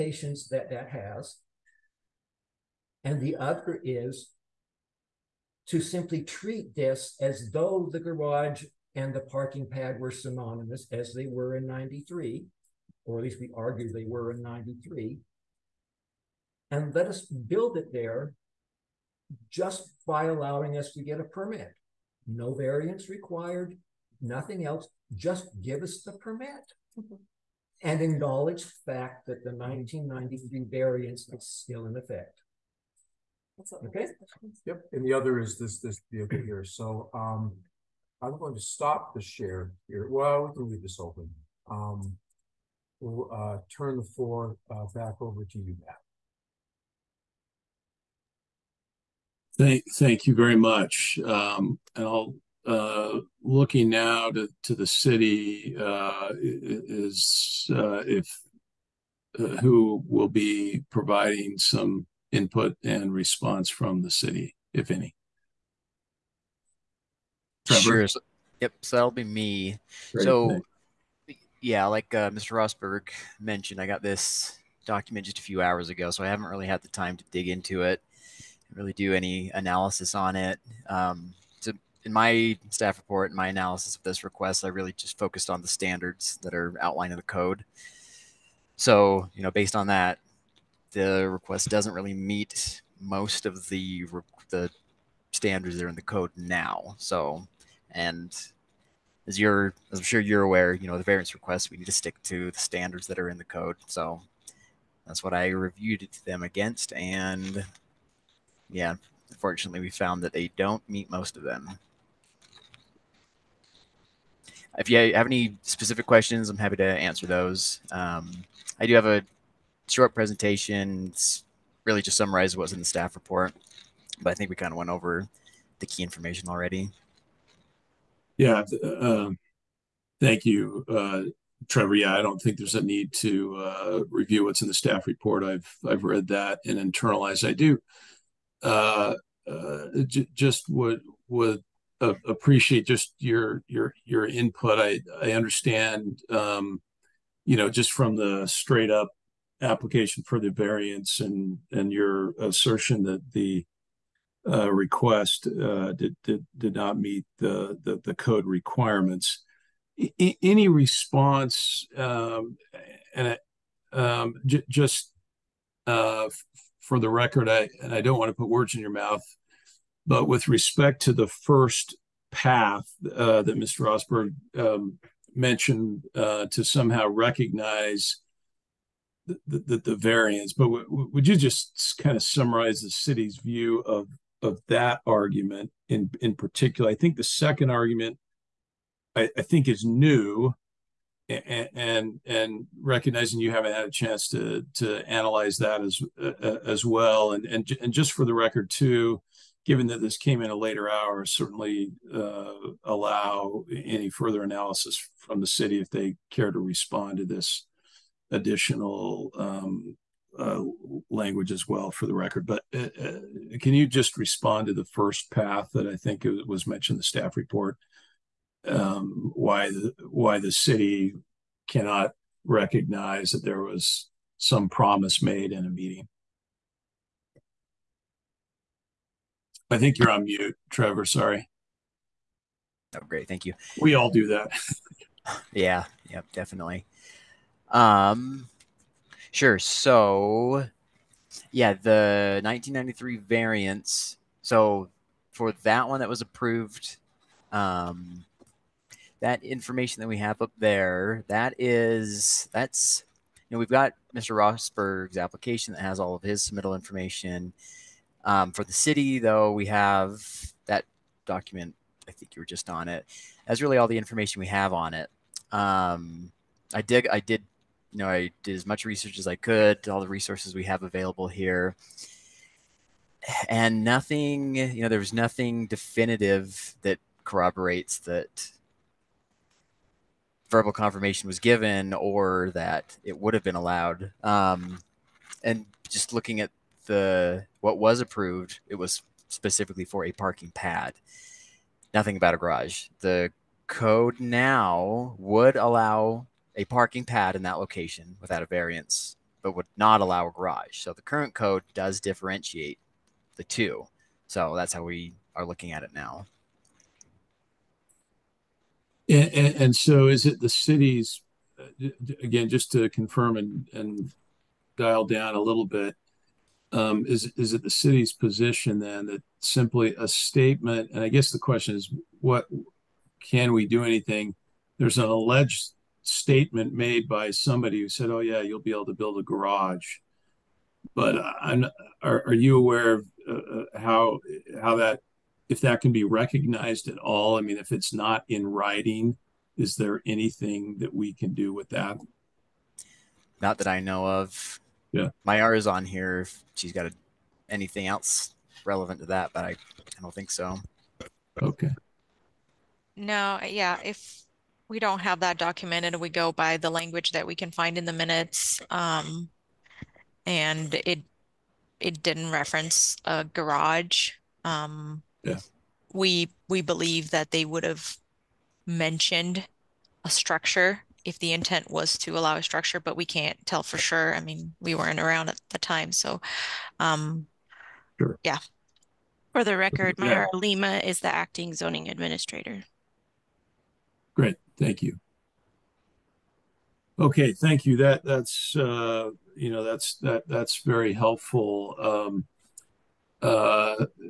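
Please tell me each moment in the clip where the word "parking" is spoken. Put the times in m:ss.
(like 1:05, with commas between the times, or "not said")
0:09, 4:50, 4:56.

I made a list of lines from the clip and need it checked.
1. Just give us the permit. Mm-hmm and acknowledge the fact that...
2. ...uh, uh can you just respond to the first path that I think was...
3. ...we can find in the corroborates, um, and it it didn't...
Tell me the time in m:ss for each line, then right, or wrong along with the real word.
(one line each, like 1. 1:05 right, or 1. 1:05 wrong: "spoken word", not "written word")
1. 0:25 right
2. 3:32 right
3. 5:57 wrong: "minutes", not "corroborates".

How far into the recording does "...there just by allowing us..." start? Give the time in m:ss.
0:17.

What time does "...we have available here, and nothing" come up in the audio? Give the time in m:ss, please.
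4:30.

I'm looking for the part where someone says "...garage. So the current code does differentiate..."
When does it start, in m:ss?
5:00.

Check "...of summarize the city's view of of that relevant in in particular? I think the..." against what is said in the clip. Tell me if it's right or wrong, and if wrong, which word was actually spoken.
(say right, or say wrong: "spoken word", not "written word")
wrong: "argument", not "relevant".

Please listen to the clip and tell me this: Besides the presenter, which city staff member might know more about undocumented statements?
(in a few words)
Mayara.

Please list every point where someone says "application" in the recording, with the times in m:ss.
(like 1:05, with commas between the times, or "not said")
2:29, 4:15.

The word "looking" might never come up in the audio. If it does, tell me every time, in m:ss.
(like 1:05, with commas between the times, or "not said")
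0:53, 4:46, 5:05.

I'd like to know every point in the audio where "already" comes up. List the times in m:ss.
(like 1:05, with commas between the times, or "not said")
2:06.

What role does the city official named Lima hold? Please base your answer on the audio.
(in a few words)
acting zoning administrator.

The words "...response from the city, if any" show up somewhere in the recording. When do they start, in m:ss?
1:03.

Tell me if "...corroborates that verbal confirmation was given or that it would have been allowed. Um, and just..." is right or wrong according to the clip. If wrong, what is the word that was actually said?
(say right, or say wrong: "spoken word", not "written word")
right.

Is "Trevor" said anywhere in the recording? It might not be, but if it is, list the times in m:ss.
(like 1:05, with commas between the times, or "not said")
1:07, 2:11, 3:50.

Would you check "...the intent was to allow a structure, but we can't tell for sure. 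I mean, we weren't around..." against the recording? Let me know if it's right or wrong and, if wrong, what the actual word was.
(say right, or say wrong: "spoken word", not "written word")
right.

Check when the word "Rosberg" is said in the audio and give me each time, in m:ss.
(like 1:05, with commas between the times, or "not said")
1:12, 2:53, 4:14.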